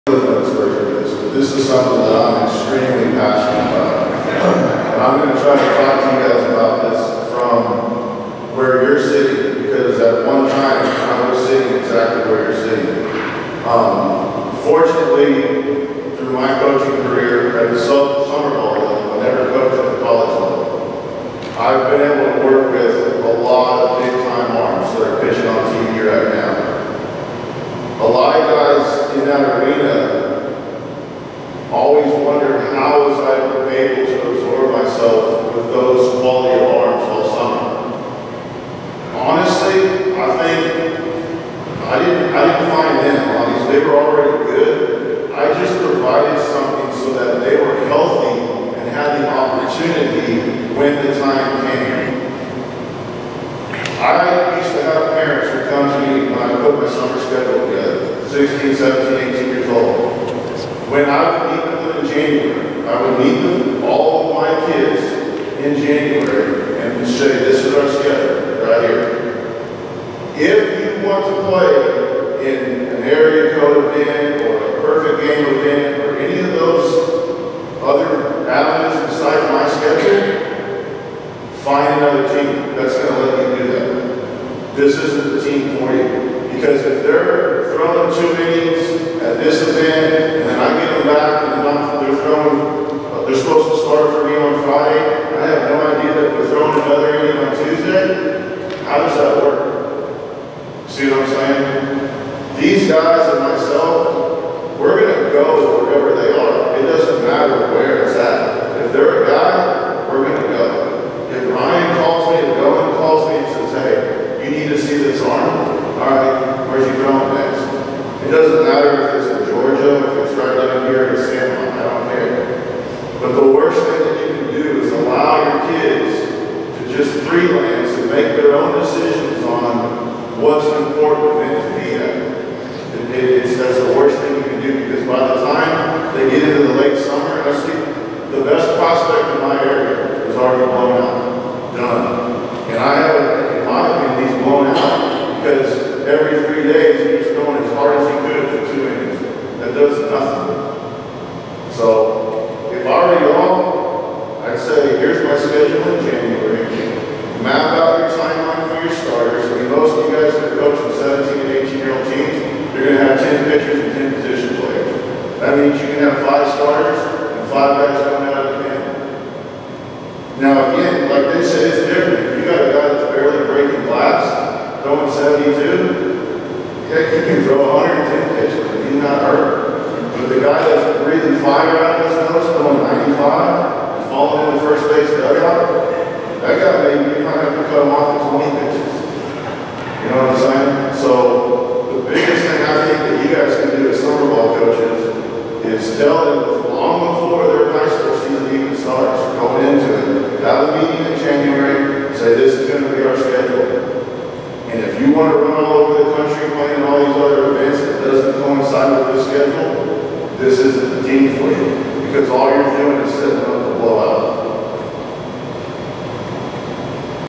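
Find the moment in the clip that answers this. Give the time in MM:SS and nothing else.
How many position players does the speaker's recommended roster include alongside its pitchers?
02:44.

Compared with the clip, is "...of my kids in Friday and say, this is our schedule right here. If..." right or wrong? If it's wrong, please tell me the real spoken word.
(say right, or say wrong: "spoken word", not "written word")
wrong: "January", not "Friday".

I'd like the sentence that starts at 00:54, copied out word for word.
I used to have parents who come to me when I put my summer schedule together, 16, 17, 18 years old.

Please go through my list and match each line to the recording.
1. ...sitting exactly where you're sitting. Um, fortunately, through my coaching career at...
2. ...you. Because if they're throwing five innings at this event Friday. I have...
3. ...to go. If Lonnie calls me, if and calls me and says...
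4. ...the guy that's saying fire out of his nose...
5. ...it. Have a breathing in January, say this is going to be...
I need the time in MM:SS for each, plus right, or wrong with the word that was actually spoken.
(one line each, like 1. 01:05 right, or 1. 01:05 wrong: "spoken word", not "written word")
1. 00:11 right
2. 01:25 wrong: "two", not "five"
3. 01:50 wrong: "Ryan", not "Lonnie"
4. 03:00 wrong: "breathing", not "saying"
5. 03:19 wrong: "meeting", not "breathing".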